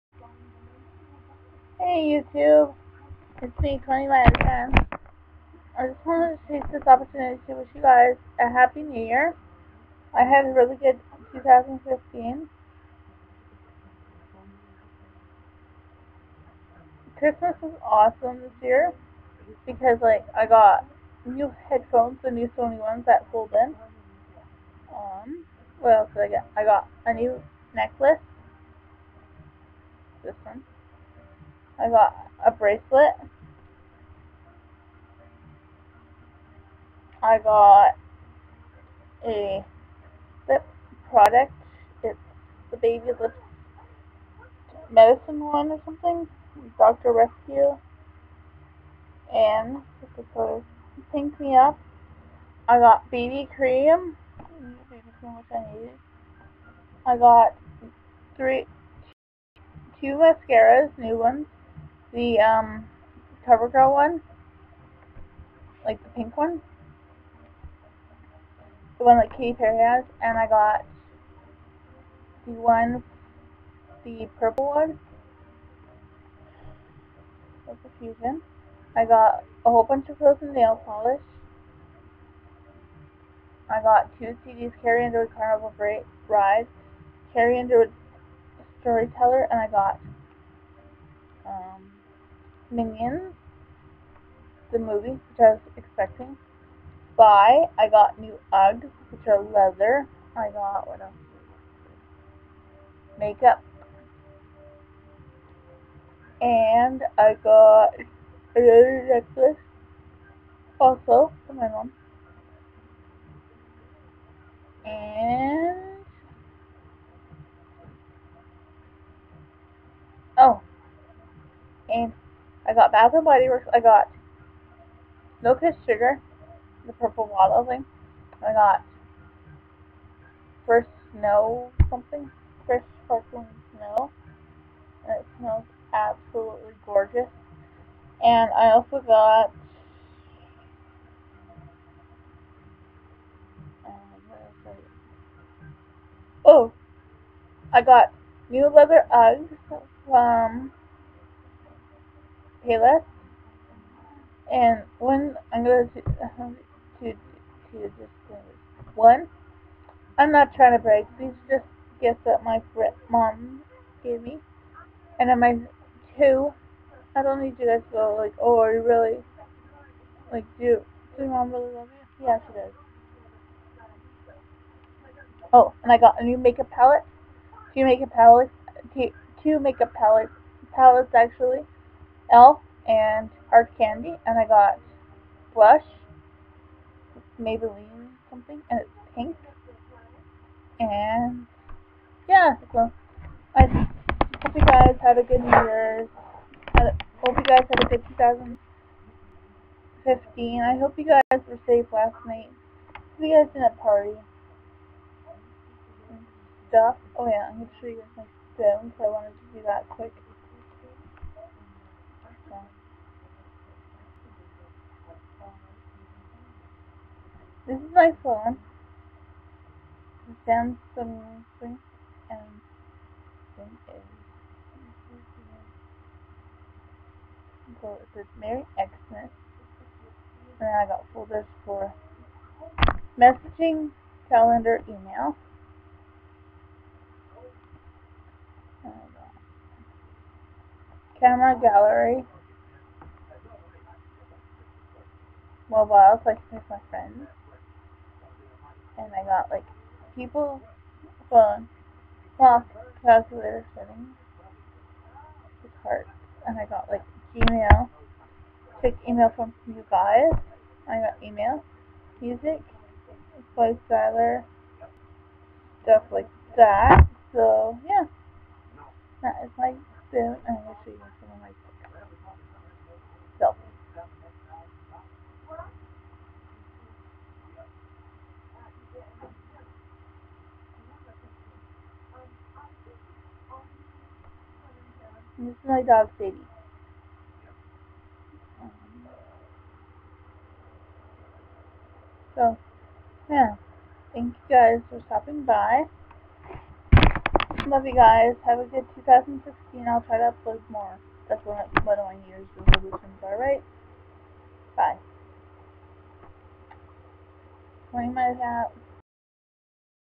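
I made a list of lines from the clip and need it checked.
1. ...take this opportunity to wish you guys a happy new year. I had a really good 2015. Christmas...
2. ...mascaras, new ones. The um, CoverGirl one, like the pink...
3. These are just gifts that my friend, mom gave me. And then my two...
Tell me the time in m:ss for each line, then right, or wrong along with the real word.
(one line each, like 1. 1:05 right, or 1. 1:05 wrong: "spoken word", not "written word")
1. 0:06 right
2. 1:00 right
3. 2:41 right.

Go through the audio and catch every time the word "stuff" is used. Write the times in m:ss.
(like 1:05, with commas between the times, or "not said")
3:26, 4:25.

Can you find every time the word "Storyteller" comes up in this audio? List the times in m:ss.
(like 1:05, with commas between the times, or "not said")
1:28.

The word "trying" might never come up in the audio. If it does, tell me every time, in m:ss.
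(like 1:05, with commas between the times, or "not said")
2:40.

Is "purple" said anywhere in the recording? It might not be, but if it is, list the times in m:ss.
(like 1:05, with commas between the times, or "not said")
1:14, 2:06.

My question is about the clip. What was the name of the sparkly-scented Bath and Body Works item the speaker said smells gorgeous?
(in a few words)
First Sparkling Snow.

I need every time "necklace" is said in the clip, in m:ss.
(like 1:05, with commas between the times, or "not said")
0:27, 1:49.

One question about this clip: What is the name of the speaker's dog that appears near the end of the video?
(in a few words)
Sadie.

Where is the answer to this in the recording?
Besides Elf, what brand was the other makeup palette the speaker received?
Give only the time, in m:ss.
3:03.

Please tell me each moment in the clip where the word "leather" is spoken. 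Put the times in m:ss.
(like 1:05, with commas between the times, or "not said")
1:39, 2:28.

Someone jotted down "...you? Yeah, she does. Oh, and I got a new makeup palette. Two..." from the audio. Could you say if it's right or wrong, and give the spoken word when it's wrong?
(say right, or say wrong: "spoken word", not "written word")
right.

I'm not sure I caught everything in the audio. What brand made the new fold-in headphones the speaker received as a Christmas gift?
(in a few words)
Sony.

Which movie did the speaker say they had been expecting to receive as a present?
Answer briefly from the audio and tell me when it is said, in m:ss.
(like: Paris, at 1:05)
Minions, at 1:32.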